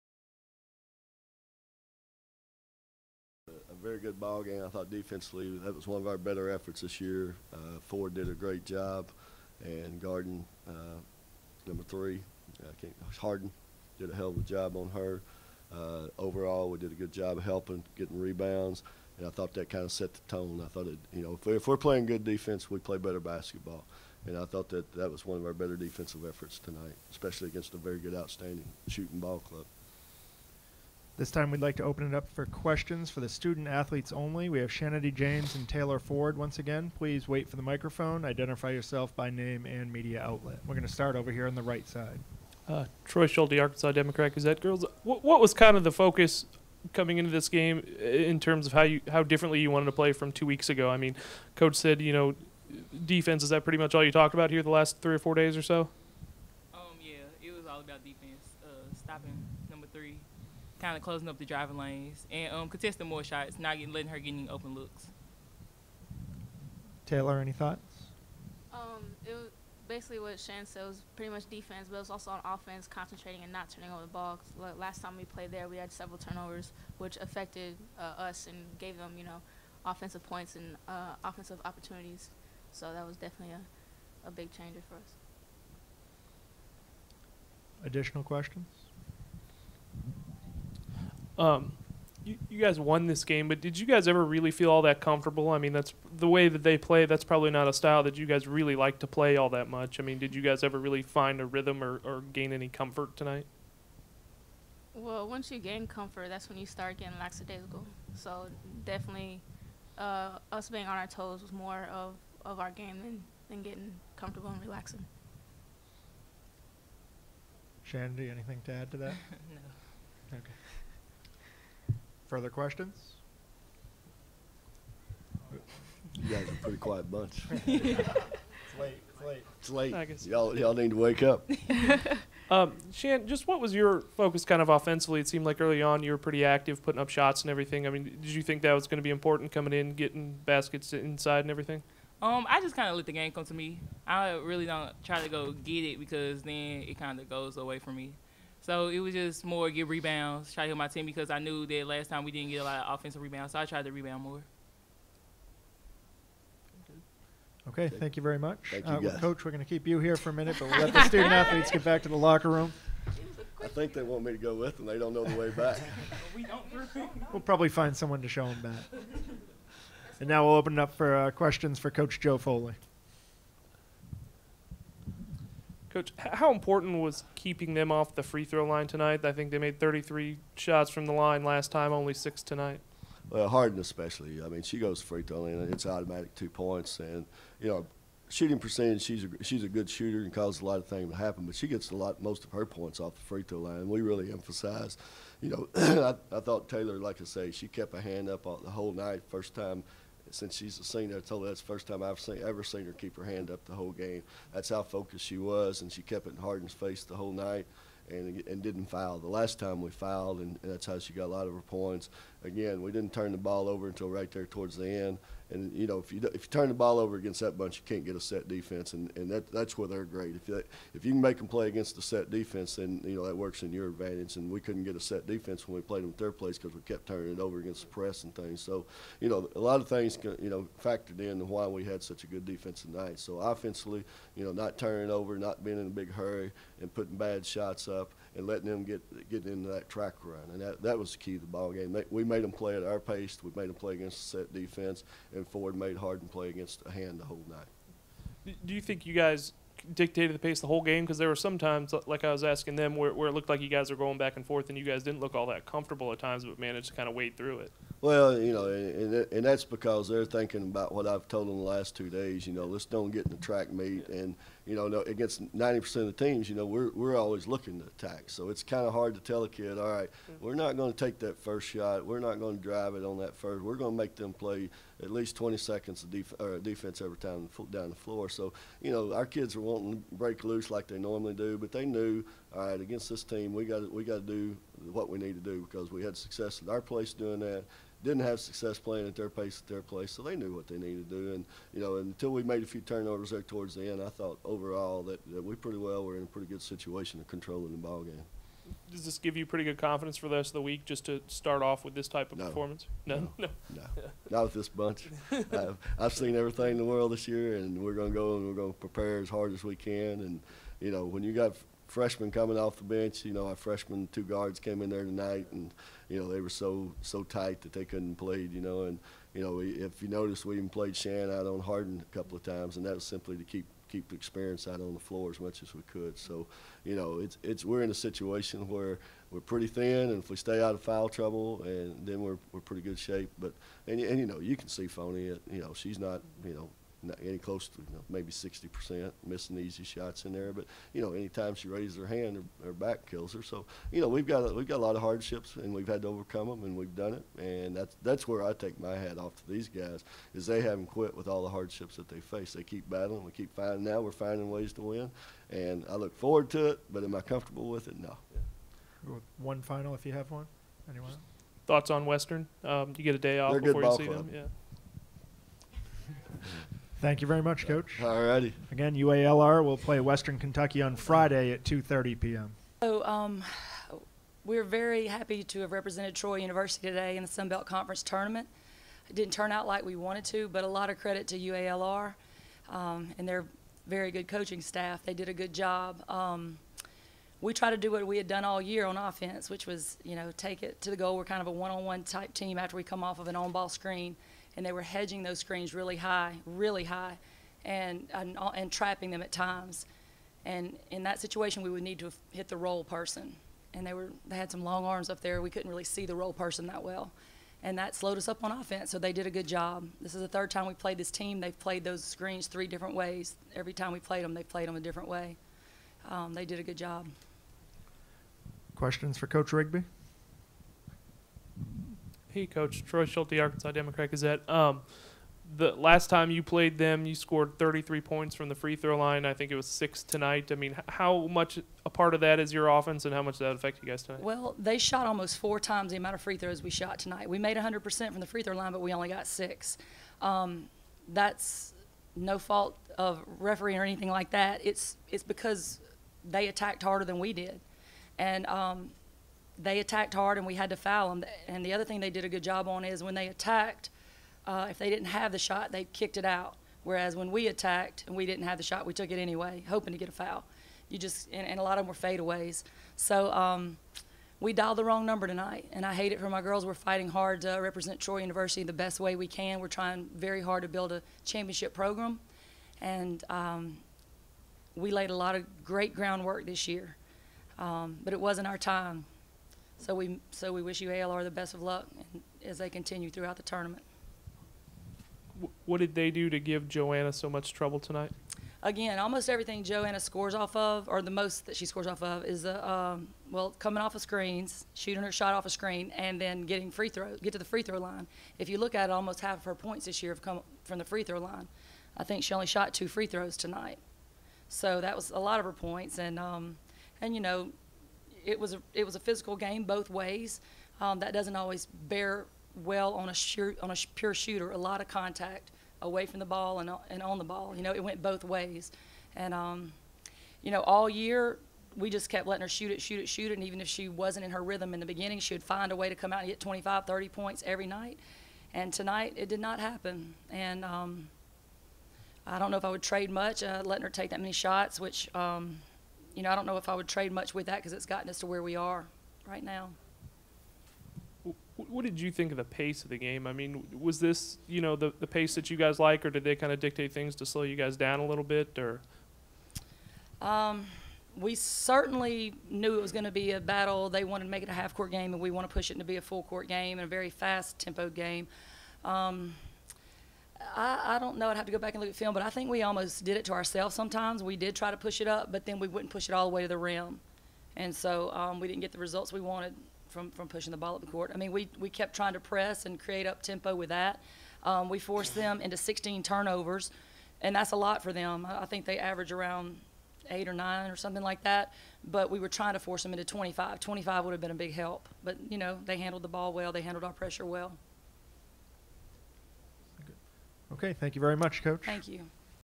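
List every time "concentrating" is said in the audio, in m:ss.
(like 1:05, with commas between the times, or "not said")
1:12.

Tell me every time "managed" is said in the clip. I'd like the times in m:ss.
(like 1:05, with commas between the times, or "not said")
4:16.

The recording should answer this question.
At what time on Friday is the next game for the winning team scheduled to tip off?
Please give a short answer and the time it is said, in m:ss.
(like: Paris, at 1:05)
2:30 p.m., at 6:11.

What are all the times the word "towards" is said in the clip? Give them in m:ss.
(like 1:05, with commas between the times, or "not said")
3:34, 4:53.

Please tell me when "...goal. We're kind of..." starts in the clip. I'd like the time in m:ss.
6:30.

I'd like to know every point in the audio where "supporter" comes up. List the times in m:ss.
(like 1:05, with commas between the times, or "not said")
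not said.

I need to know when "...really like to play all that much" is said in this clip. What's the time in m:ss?
1:38.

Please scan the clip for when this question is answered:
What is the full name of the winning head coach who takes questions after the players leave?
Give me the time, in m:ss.
2:52.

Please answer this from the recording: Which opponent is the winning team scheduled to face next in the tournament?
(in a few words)
Western Kentucky.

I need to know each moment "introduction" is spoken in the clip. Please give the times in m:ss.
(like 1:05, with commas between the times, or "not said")
not said.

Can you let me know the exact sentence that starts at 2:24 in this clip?
I really don't try to go get it because then it kind of goes away from me.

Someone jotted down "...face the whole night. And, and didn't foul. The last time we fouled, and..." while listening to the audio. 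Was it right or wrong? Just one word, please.
right.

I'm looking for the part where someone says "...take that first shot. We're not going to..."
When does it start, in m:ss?
4:31.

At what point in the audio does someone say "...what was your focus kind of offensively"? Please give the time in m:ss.
2:13.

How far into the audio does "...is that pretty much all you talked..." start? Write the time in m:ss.
0:53.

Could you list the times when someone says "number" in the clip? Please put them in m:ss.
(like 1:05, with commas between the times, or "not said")
0:11, 0:59, 7:45.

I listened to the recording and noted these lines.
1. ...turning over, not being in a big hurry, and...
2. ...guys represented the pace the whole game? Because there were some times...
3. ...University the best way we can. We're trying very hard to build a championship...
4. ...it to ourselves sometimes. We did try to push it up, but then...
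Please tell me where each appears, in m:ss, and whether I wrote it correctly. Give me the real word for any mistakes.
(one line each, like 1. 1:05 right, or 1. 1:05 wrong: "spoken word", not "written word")
1. 3:54 right
2. 4:09 wrong: "dictated", not "represented"
3. 7:48 right
4. 9:23 right.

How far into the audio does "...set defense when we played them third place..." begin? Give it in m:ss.
3:44.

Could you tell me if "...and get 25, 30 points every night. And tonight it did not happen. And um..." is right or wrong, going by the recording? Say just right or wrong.
right.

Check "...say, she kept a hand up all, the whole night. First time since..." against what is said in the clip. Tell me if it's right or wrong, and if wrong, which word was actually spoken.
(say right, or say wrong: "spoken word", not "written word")
right.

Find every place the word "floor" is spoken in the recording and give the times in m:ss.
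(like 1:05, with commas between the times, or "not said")
4:37, 5:25.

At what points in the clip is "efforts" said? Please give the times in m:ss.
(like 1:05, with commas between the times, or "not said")
0:06, 0:26.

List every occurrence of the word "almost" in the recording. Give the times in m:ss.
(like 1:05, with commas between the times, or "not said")
7:15, 8:08, 8:18, 9:22.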